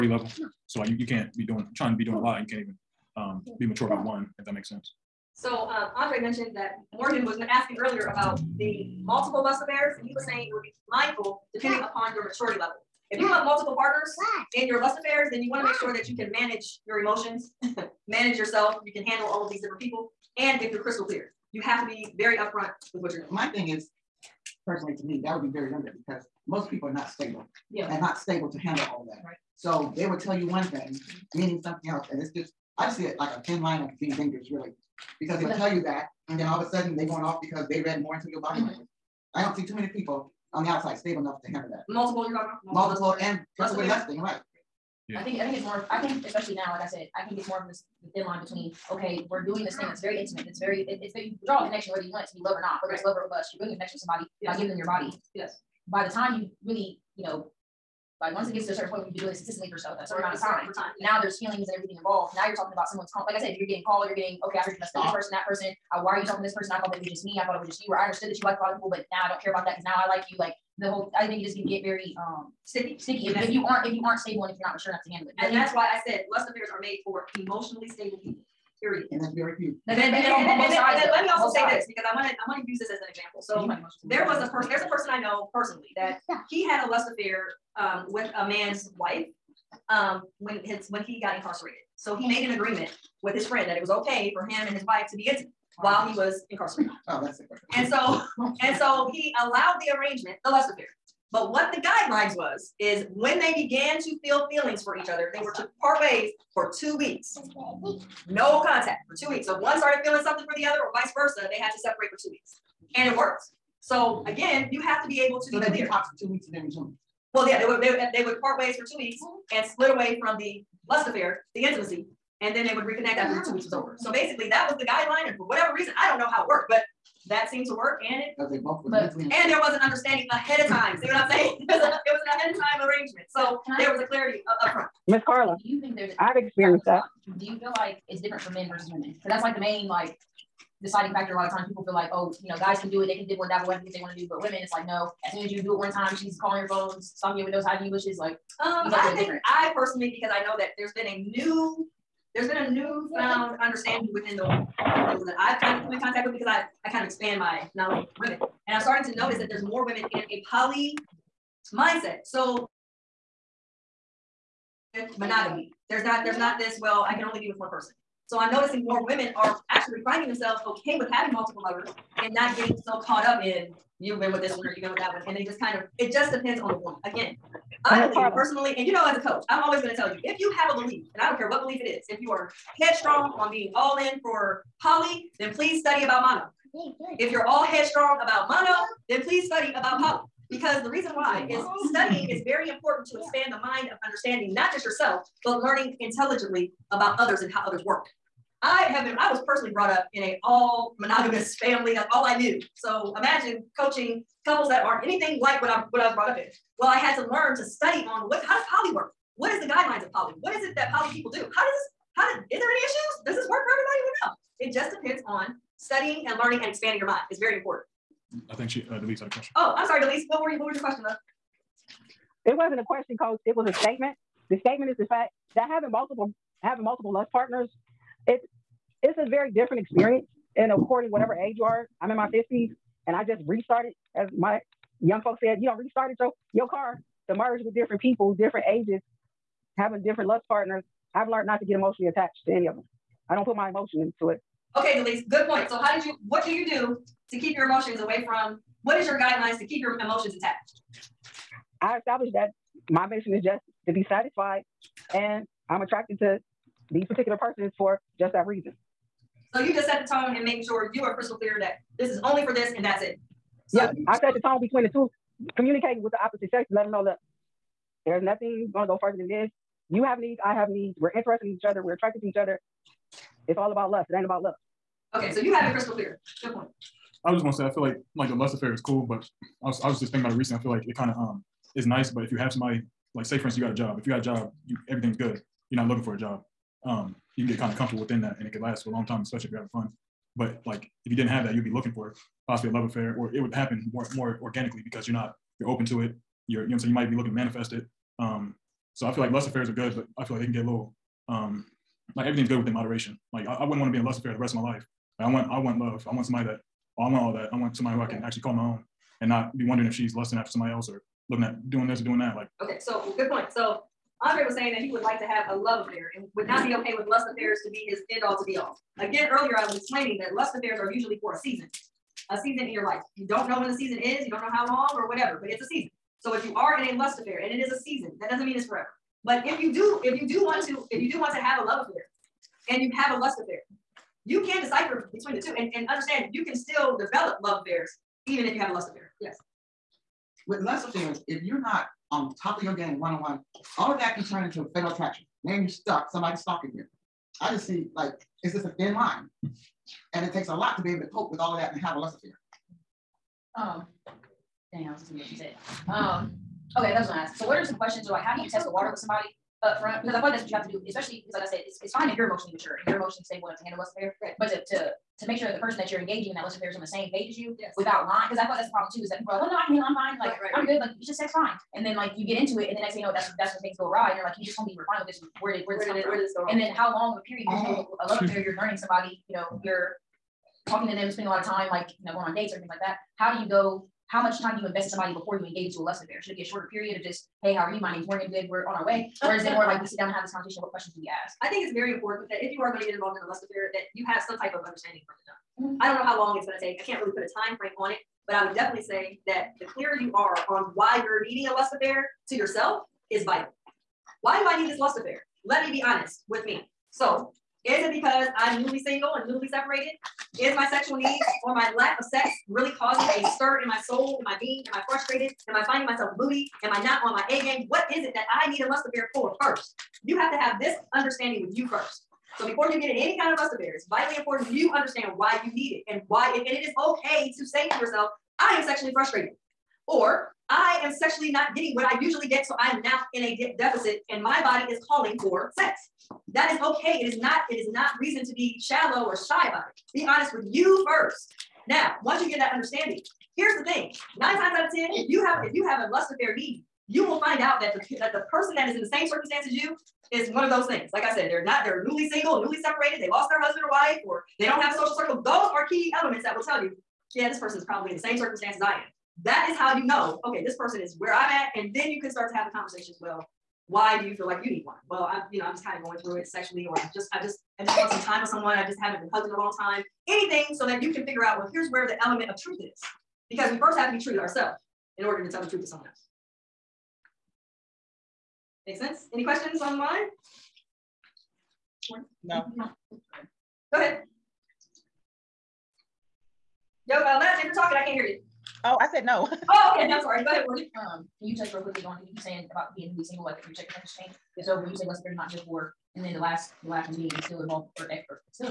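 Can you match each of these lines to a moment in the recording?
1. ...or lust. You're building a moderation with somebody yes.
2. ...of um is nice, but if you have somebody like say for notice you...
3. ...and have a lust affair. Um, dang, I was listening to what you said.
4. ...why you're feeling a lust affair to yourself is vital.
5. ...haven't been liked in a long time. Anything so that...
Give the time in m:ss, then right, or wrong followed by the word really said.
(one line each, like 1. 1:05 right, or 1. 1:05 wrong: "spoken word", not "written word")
1. 0:53 wrong: "connection", not "moderation"
2. 4:41 wrong: "instance", not "notice"
3. 5:51 right
4. 6:40 wrong: "needing", not "feeling"
5. 7:48 wrong: "hugged", not "liked".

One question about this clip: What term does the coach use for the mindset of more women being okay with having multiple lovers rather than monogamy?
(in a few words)
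poly mindset.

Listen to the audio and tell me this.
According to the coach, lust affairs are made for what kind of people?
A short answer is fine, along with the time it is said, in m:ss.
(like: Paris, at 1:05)
emotionally stable people, at 1:17.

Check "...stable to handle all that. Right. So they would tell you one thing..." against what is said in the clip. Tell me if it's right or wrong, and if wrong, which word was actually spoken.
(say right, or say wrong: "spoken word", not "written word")
right.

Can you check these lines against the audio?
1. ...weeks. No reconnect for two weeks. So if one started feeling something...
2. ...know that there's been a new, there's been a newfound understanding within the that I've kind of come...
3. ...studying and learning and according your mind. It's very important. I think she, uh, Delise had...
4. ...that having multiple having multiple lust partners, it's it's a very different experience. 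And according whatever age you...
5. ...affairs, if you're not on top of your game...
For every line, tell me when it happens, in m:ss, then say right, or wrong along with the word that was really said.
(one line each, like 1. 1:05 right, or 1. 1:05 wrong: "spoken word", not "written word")
1. 1:46 wrong: "contact", not "reconnect"
2. 2:30 right
3. 3:35 wrong: "expanding", not "according"
4. 3:45 right
5. 5:40 right.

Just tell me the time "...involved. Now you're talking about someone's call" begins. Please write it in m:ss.
1:02.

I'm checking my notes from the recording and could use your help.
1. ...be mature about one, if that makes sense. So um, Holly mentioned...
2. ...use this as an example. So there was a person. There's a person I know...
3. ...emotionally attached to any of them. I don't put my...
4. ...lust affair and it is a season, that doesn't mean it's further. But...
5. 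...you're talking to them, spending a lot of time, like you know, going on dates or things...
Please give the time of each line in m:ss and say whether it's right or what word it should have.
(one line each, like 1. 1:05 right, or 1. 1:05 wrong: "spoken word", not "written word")
1. 0:03 wrong: "Andre", not "Holly"
2. 1:22 right
3. 4:01 right
4. 5:26 wrong: "forever", not "further"
5. 6:19 right.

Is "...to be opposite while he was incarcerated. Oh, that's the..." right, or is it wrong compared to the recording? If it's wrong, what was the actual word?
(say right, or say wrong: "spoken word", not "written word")
wrong: "intimate", not "opposite".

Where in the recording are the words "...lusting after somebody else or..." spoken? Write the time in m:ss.
5:10.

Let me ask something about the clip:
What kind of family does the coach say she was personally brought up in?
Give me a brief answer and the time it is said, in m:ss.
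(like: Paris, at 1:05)
monogamous, at 3:20.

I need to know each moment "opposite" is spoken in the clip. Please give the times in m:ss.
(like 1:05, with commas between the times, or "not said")
4:26.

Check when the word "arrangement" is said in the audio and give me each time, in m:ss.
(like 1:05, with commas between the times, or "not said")
1:39, 2:12.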